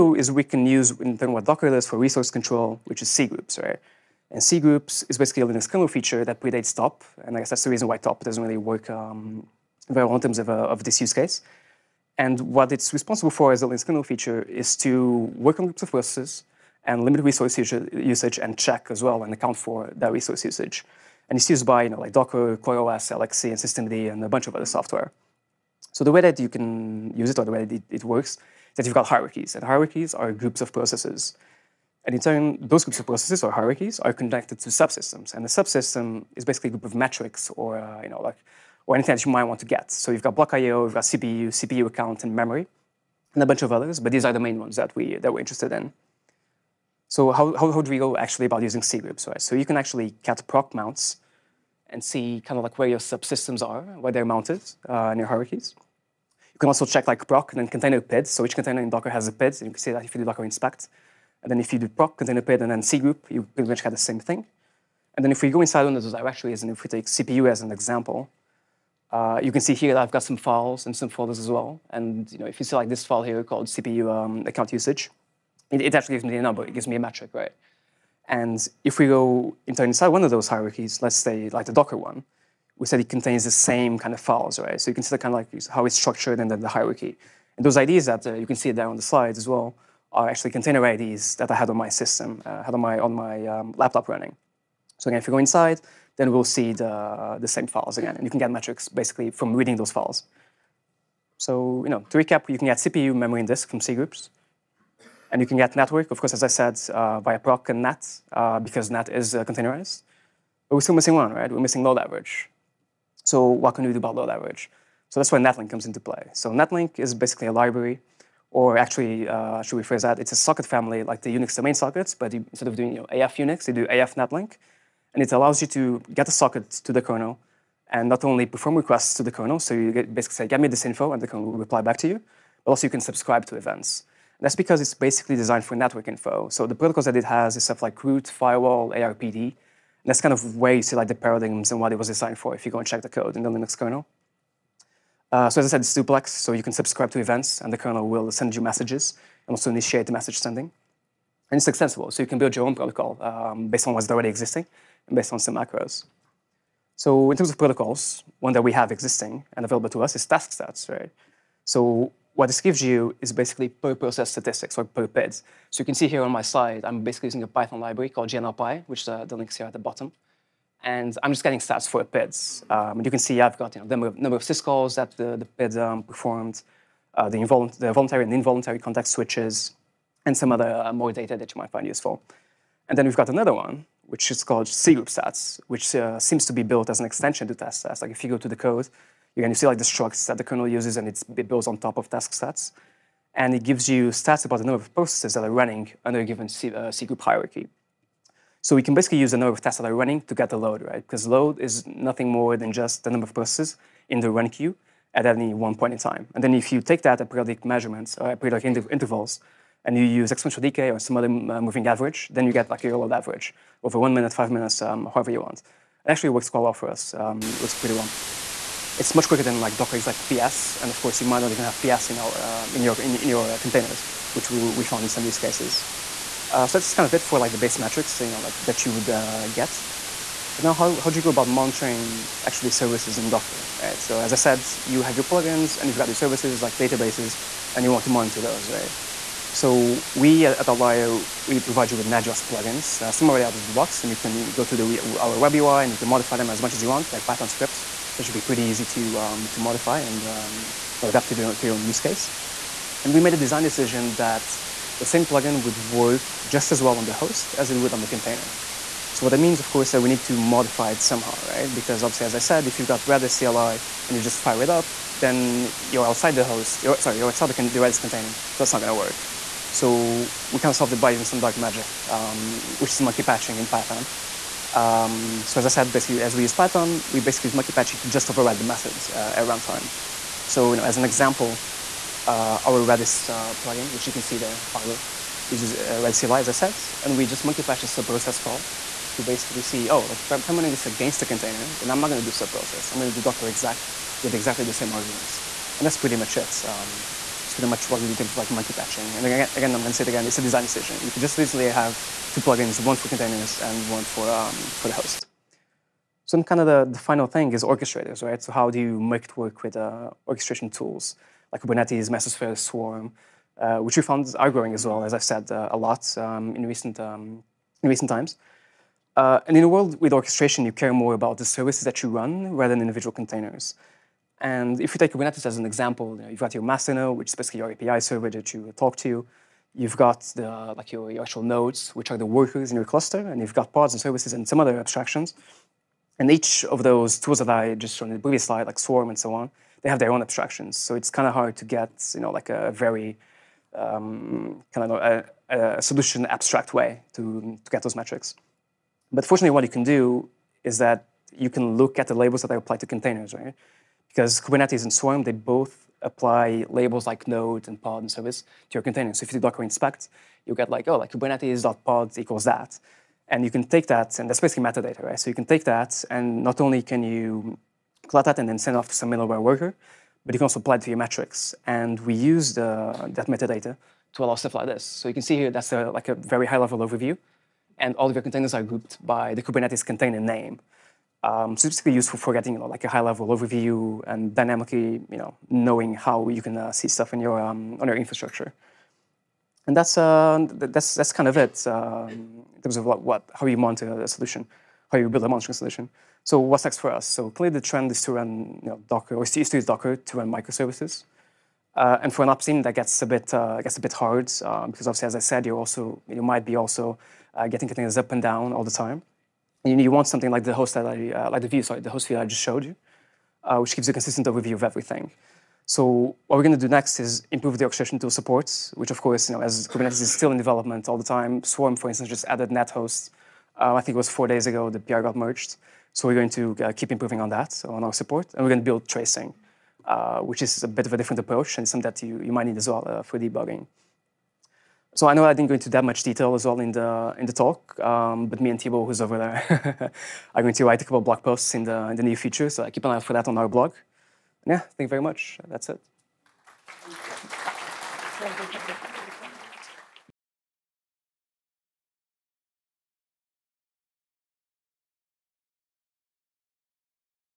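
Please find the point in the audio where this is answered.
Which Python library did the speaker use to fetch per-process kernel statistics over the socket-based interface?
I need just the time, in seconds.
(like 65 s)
168 s.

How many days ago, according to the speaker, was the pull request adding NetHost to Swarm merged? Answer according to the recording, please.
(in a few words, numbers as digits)
4.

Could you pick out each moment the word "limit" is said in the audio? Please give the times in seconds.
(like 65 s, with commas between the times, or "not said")
17 s.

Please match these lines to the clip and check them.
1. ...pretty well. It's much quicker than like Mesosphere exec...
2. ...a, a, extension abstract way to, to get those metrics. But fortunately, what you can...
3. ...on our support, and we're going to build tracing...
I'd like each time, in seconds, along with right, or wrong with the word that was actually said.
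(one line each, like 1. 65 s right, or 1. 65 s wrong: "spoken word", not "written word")
1. 217 s wrong: "Docker", not "Mesosphere"
2. 345 s wrong: "solution", not "extension"
3. 427 s right.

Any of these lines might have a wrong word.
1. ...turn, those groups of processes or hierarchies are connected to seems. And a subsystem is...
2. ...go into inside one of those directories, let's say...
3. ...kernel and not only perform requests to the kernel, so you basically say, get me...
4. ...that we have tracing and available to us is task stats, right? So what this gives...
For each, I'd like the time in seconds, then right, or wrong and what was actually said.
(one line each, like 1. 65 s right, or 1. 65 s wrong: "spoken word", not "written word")
1. 32 s wrong: "subsystems", not "seems"
2. 79 s wrong: "hierarchies", not "directories"
3. 127 s right
4. 158 s wrong: "existing", not "tracing".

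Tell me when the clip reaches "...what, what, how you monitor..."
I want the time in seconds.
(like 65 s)
392 s.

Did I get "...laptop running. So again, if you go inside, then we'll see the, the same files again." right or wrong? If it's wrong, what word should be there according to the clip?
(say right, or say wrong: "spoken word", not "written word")
right.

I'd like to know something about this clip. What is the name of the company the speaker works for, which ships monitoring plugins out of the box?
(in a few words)
Outlyer.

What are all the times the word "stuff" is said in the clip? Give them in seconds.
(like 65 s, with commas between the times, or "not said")
137 s, 374 s, 386 s.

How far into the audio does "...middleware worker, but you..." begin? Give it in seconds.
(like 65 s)
369 s.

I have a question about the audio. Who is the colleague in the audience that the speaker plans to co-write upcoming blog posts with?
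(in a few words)
Thibault.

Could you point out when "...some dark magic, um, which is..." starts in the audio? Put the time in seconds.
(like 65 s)
271 s.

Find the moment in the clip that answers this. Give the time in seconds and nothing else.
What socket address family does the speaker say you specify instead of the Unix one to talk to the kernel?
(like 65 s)
123 s.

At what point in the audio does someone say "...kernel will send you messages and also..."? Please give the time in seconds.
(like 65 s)
147 s.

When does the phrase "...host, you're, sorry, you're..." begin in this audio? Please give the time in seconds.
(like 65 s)
266 s.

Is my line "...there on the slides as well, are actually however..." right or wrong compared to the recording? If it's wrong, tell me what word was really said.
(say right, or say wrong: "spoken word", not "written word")
wrong: "container", not "however".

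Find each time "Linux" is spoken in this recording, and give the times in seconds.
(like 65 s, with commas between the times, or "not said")
5 s, 13 s, 143 s.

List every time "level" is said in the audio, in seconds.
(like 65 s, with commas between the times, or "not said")
376 s, 383 s.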